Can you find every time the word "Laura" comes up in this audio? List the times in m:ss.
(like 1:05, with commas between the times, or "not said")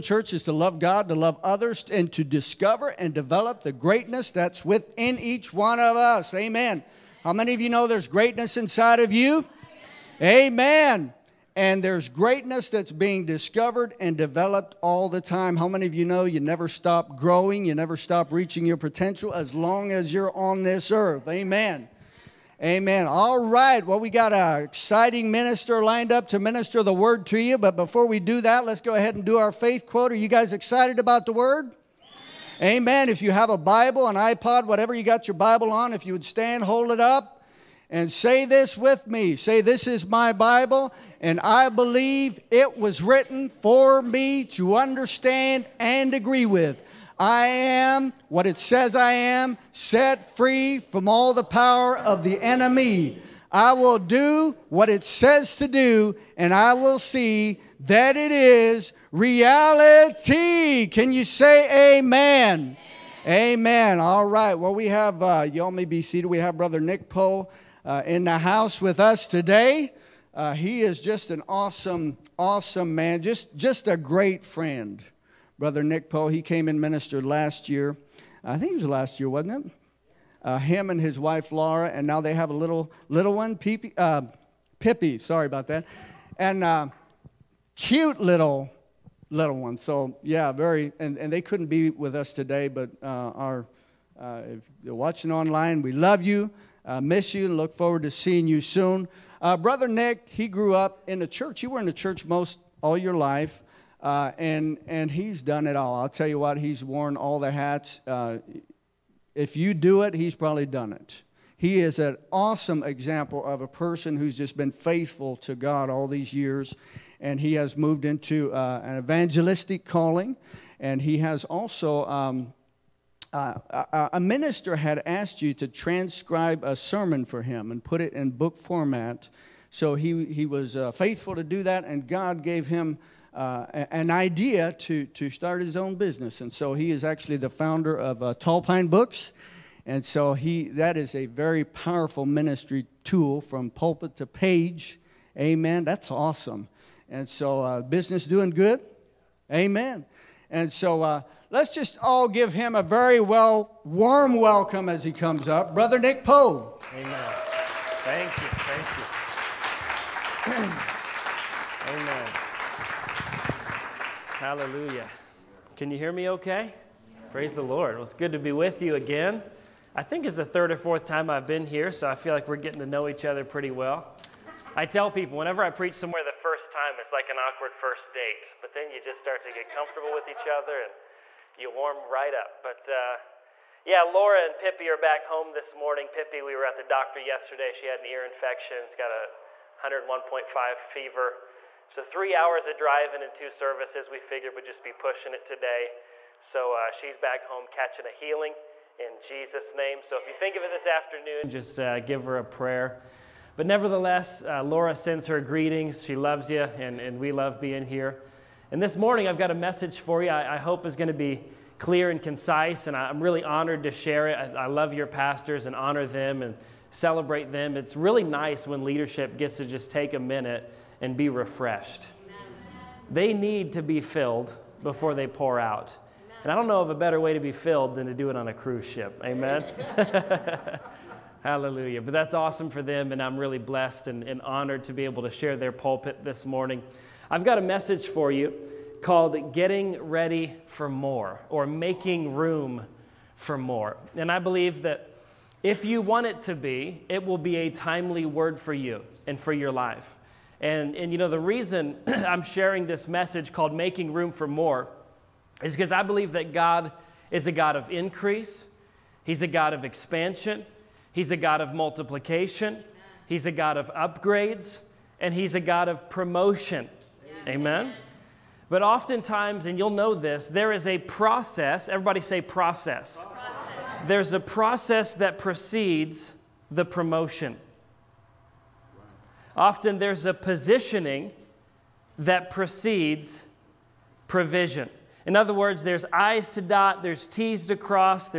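1:21, 3:04, 3:24.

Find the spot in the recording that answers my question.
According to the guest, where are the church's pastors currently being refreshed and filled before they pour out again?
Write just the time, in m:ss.
3:48.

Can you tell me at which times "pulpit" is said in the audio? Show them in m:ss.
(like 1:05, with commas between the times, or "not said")
2:23, 3:55.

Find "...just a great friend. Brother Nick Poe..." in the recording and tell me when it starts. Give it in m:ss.
1:13.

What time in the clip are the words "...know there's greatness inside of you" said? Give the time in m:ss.
0:07.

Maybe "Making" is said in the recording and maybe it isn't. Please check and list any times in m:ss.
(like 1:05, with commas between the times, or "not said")
4:01, 4:13.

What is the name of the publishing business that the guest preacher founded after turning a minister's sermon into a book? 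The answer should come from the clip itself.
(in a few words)
Tall Pine Books.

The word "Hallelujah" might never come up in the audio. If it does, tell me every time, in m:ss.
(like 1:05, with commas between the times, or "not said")
2:44, 3:51.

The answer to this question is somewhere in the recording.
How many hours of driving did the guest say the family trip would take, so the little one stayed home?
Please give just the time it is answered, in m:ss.
3:12.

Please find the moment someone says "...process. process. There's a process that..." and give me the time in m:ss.
4:32.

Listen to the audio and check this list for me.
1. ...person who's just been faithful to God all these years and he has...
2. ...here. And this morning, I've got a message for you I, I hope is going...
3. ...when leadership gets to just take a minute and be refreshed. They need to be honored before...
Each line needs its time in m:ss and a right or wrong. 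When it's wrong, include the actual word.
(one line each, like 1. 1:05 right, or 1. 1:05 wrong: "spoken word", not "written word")
1. 1:53 right
2. 3:27 right
3. 3:38 wrong: "filled", not "honored".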